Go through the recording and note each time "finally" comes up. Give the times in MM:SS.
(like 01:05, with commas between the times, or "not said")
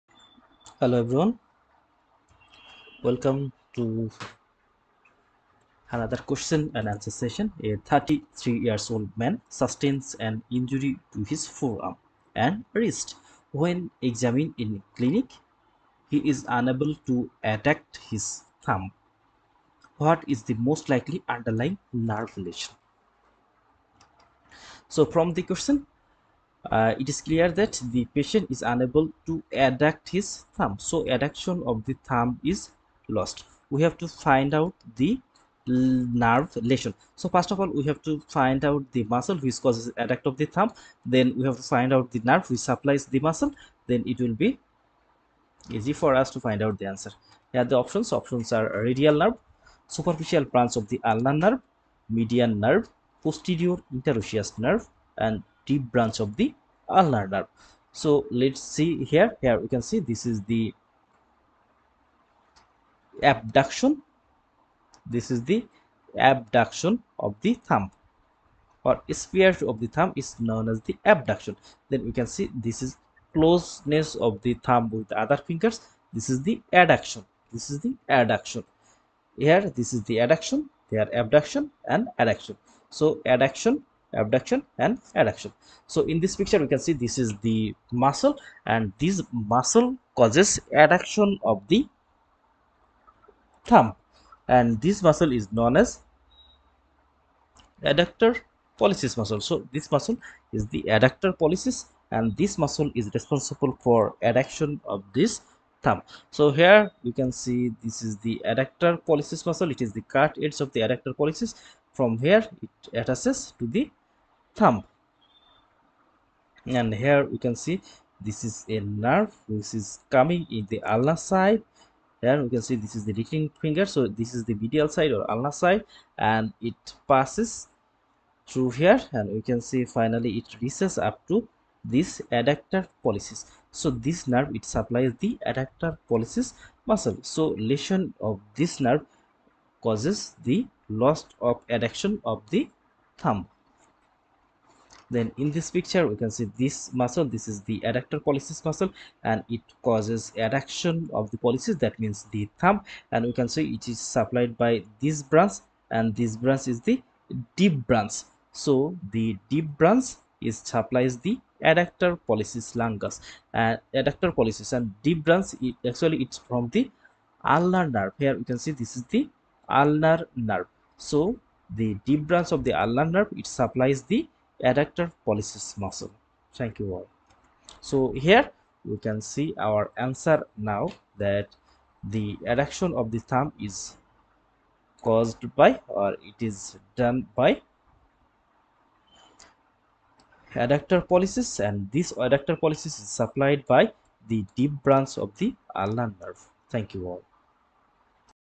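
02:09.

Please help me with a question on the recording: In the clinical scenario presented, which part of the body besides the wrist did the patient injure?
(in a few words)
forearm.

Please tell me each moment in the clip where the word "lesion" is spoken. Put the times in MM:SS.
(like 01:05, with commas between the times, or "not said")
00:22, 00:36, 02:17.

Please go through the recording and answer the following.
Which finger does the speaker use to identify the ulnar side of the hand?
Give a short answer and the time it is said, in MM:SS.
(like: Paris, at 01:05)
ring finger, at 02:03.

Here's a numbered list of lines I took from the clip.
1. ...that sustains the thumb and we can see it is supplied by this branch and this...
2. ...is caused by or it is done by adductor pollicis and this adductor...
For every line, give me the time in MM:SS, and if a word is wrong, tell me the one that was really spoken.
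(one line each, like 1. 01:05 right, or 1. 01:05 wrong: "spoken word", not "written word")
1. 02:31 wrong: "means", not "sustains"
2. 03:03 right.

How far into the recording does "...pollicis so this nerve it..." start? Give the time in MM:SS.
02:13.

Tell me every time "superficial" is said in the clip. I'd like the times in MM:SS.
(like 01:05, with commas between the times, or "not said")
00:49.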